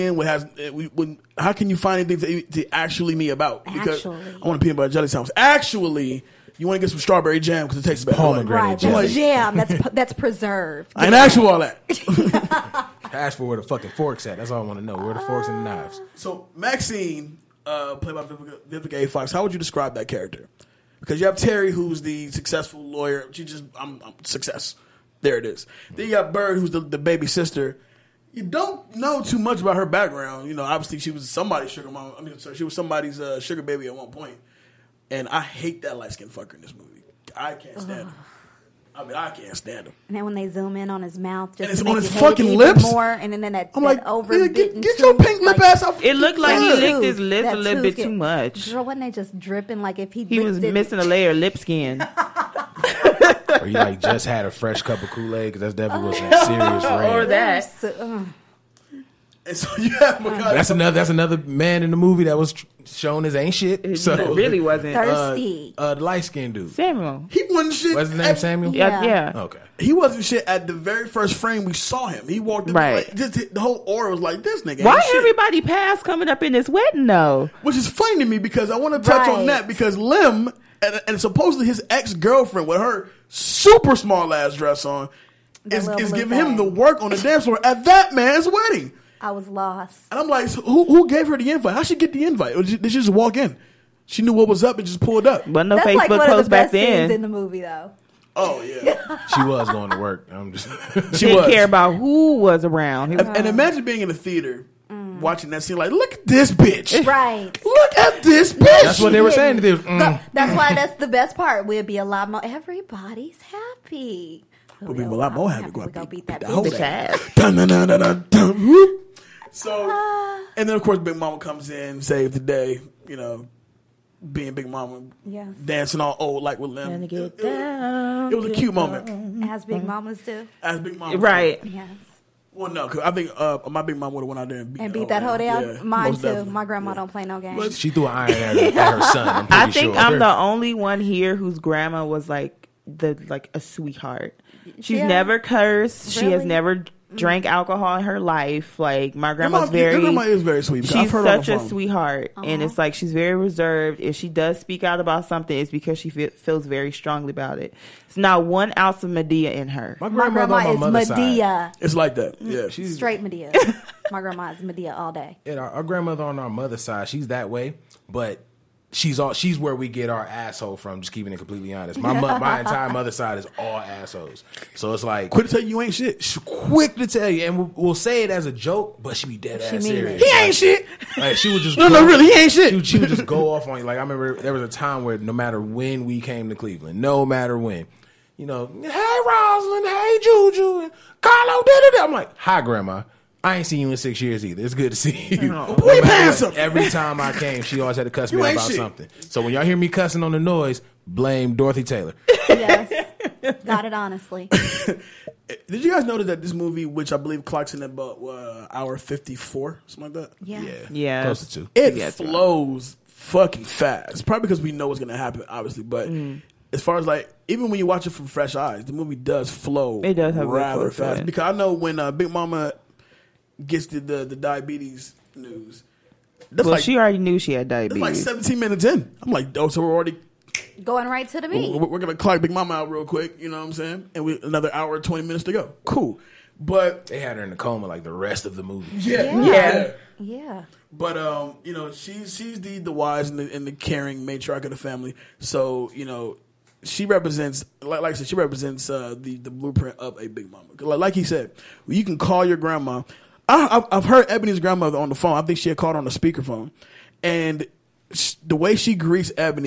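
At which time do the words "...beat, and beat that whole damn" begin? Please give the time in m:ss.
2:14.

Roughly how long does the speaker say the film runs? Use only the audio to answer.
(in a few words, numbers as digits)
1 hour 54 minutes.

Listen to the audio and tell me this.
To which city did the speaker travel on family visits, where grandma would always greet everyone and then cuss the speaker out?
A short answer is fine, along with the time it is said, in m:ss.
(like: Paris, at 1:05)
Cleveland, at 3:06.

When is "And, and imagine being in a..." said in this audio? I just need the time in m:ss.
1:43.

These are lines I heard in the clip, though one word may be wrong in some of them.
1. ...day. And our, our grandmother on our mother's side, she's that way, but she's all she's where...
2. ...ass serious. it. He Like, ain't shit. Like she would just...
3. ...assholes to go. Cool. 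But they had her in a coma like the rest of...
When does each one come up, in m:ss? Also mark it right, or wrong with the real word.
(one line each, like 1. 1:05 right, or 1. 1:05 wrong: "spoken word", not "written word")
1. 2:45 right
2. 2:59 right
3. 3:55 wrong: "minutes", not "assholes".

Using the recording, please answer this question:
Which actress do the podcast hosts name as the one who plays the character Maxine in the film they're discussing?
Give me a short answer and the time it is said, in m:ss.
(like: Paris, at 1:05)
Vivica A. Fox, at 0:18.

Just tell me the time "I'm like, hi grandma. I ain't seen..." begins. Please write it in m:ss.
3:12.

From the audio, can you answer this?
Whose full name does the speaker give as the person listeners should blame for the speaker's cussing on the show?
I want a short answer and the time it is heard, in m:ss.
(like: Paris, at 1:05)
Dorothy Taylor, at 3:21.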